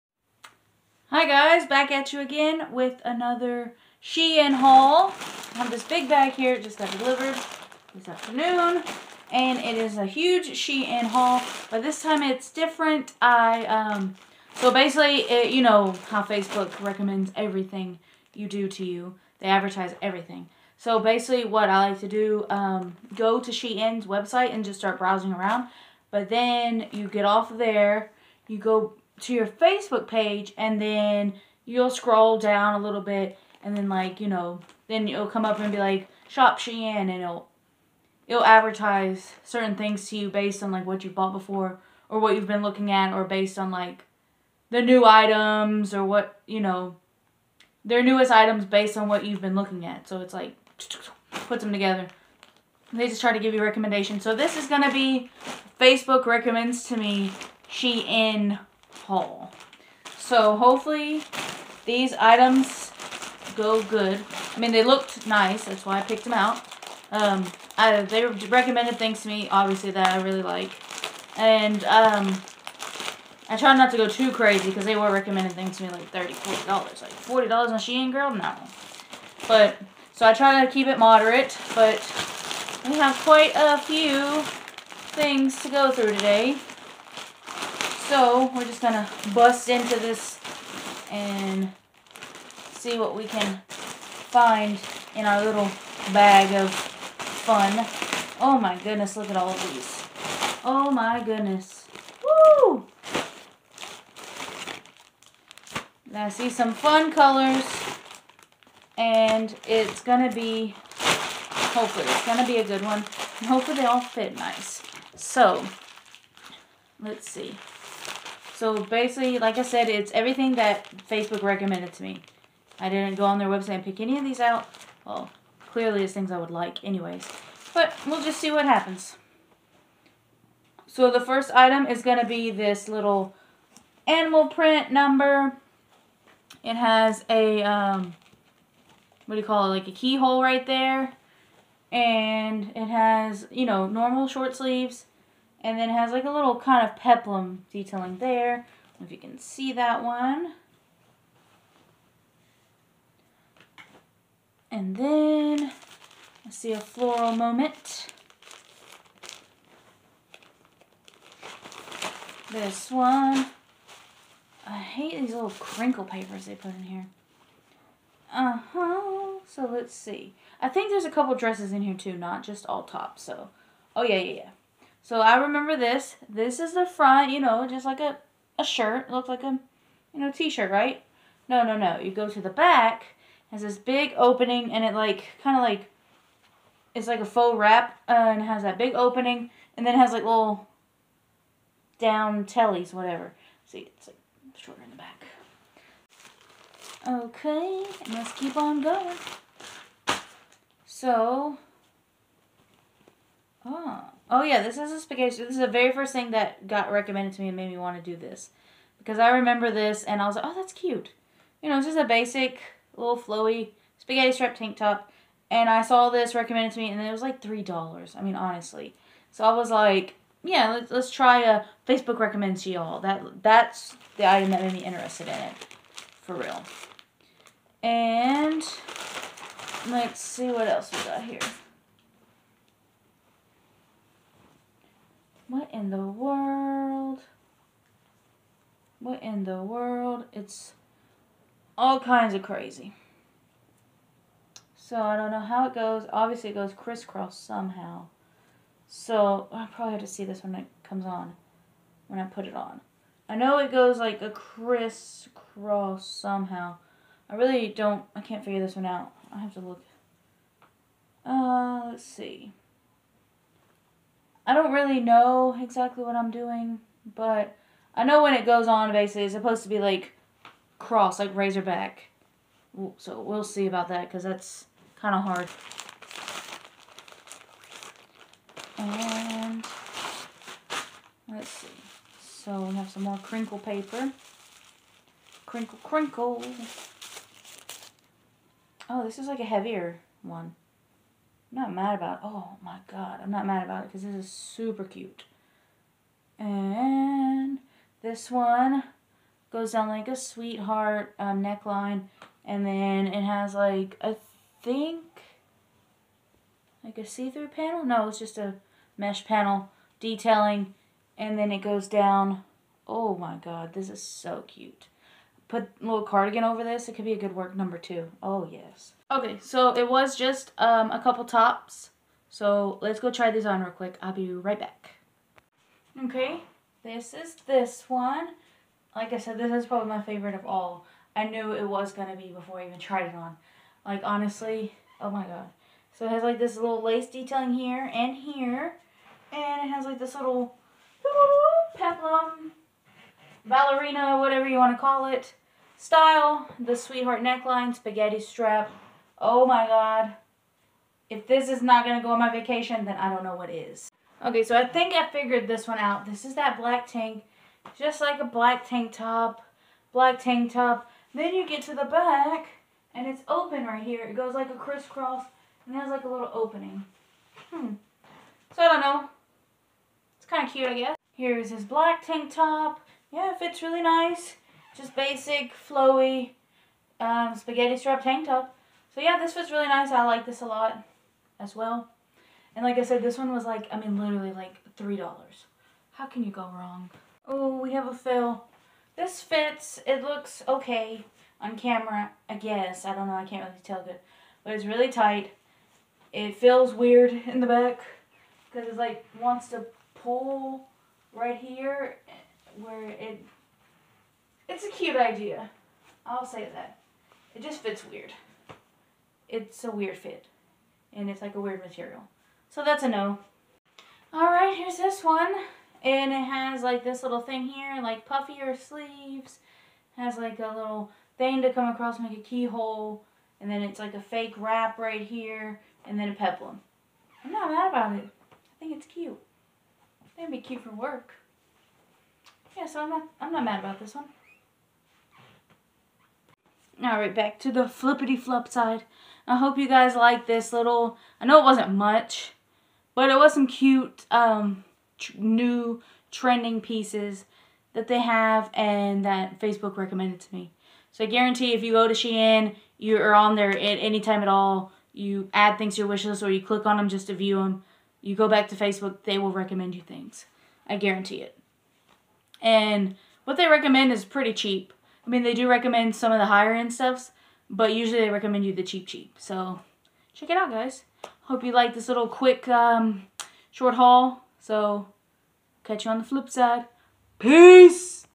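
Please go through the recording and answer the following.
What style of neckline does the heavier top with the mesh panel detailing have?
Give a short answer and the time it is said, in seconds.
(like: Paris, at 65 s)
Sweetheart neckline, at 300 s.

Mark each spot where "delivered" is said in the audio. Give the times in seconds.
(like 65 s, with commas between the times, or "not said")
6 s.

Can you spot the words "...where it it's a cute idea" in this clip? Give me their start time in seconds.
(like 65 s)
402 s.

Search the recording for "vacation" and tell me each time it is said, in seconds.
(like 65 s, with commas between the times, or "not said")
352 s.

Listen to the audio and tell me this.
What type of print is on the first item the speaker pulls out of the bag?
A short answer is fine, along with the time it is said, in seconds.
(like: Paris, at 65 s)
Animal print, at 134 s.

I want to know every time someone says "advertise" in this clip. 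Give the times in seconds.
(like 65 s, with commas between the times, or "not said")
19 s, 38 s.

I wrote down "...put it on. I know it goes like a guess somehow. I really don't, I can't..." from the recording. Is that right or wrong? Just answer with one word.
wrong.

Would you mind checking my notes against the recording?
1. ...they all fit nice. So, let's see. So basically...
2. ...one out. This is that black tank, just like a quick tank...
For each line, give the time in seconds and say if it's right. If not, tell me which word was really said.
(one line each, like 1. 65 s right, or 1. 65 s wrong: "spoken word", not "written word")
1. 113 s right
2. 355 s wrong: "black", not "quick".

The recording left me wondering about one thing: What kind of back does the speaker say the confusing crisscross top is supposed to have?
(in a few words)
Razorback.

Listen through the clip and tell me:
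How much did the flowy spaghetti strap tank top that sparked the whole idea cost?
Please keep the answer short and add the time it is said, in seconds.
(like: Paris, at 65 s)
$3, at 217 s.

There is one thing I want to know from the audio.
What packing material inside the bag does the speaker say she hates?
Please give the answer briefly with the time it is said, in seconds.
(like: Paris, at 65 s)
Crinkle papers, at 165 s.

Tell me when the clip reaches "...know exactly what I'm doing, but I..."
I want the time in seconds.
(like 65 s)
264 s.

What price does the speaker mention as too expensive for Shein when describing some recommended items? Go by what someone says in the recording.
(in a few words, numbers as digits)
$40.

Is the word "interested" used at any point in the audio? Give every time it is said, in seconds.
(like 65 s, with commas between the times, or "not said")
224 s.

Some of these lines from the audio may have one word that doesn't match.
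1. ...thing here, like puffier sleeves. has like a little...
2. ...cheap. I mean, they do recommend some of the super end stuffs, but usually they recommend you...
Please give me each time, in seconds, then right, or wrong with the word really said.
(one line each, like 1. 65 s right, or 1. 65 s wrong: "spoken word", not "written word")
1. 417 s right
2. 464 s wrong: "higher", not "super".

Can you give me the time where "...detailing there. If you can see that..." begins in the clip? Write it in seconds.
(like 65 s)
147 s.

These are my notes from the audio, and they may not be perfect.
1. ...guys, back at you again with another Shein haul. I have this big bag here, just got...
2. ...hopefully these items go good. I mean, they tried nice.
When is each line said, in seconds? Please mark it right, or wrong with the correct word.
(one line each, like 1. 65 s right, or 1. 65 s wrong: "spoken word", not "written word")
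1. 1 s right
2. 60 s wrong: "looked", not "tried".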